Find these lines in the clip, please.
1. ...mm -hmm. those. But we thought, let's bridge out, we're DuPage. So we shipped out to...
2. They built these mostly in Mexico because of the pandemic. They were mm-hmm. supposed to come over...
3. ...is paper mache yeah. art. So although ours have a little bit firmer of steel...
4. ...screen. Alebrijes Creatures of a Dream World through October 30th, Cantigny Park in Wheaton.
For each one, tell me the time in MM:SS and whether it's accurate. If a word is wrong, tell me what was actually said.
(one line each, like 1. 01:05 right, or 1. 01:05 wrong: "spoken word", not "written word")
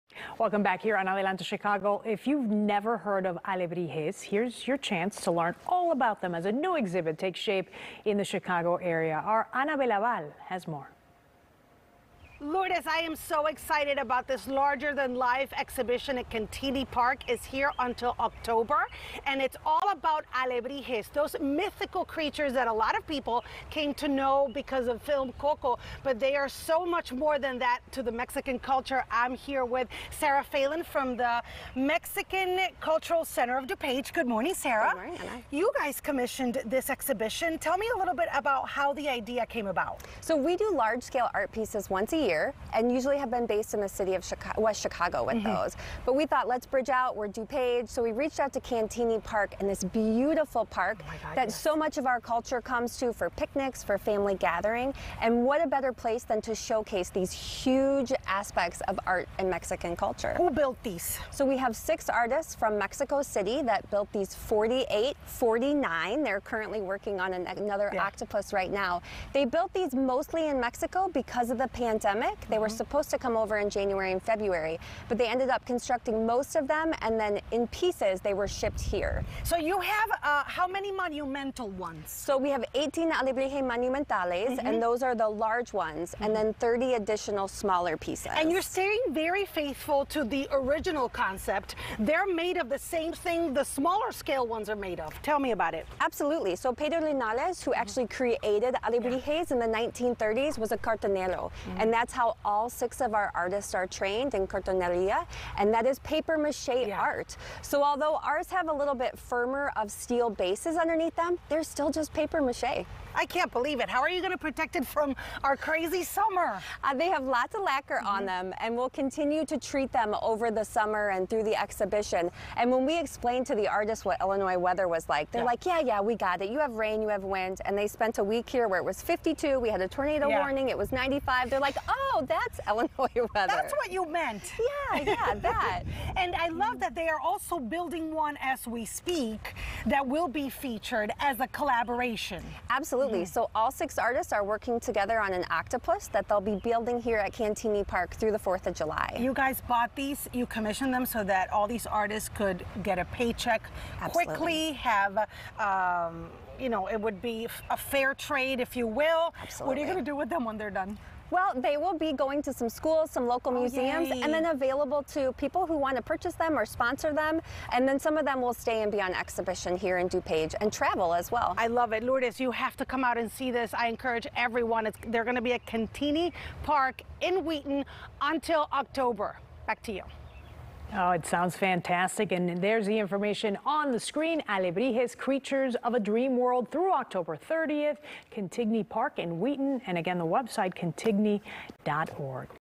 1. 00:45 wrong: "reached", not "shipped"
2. 01:09 right
3. 01:45 right
4. 03:03 right.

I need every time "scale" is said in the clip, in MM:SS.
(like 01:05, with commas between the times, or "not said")
00:40, 01:34.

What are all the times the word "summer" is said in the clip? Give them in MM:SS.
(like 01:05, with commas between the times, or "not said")
01:56, 02:00.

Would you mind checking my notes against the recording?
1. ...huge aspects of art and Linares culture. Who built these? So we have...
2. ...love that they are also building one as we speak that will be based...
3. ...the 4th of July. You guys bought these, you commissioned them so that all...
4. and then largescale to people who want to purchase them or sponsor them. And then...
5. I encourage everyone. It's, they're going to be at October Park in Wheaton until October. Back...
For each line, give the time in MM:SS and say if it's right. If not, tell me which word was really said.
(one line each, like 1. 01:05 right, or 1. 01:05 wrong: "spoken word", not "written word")
1. 00:57 wrong: "Mexican", not "Linares"
2. 02:16 wrong: "featured", not "based"
3. 02:28 right
4. 02:44 wrong: "available", not "largescale"
5. 02:53 wrong: "Cantigny", not "October".